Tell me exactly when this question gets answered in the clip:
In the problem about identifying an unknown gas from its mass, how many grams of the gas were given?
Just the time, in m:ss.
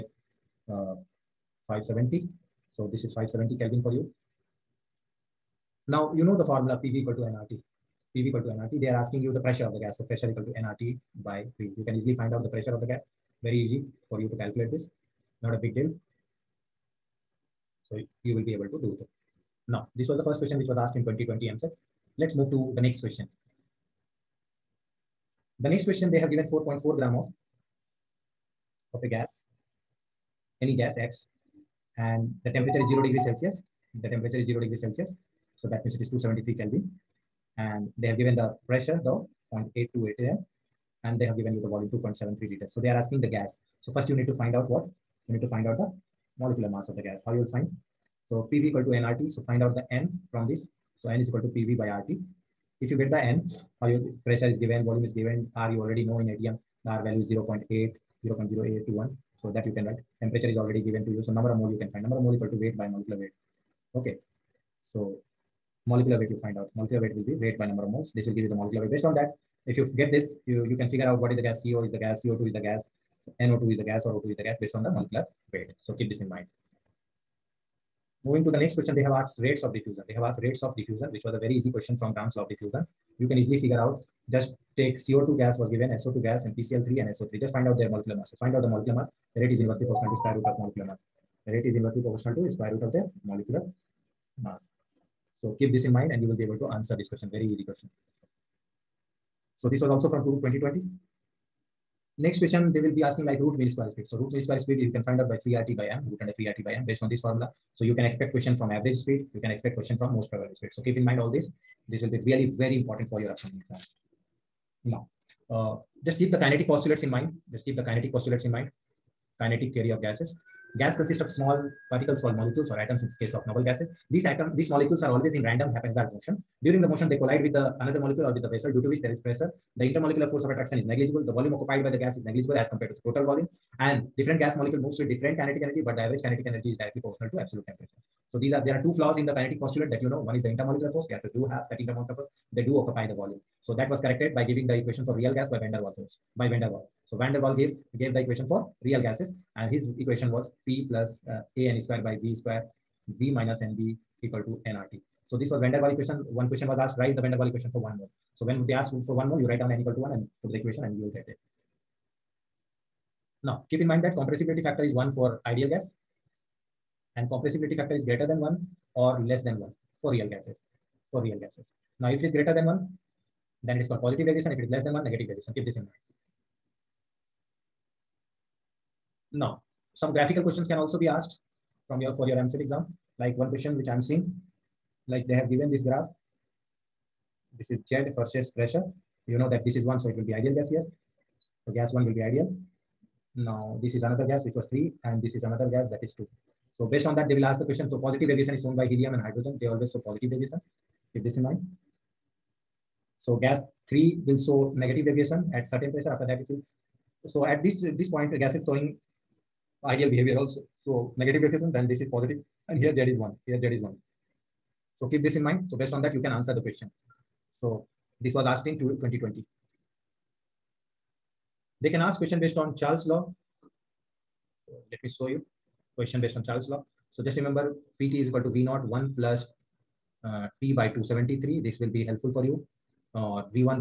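0:26.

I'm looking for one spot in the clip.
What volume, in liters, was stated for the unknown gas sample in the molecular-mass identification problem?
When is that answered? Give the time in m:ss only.
0:41.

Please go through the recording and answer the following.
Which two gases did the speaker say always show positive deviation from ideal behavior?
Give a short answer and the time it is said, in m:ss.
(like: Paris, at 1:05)
Helium and hydrogen, at 3:18.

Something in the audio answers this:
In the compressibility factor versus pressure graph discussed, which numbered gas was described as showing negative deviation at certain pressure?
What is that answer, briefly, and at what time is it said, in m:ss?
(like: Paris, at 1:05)
Gas 3, at 3:23.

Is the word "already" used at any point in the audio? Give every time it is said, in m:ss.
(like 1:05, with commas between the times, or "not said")
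0:55, 1:00.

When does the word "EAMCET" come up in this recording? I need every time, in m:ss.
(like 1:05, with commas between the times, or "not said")
0:21, 3:02.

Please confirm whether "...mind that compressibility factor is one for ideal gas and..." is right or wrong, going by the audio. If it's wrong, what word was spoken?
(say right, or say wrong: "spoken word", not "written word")
right.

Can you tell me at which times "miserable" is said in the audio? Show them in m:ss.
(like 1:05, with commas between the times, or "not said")
not said.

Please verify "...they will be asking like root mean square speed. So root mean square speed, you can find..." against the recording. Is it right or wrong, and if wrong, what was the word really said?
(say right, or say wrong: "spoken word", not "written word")
right.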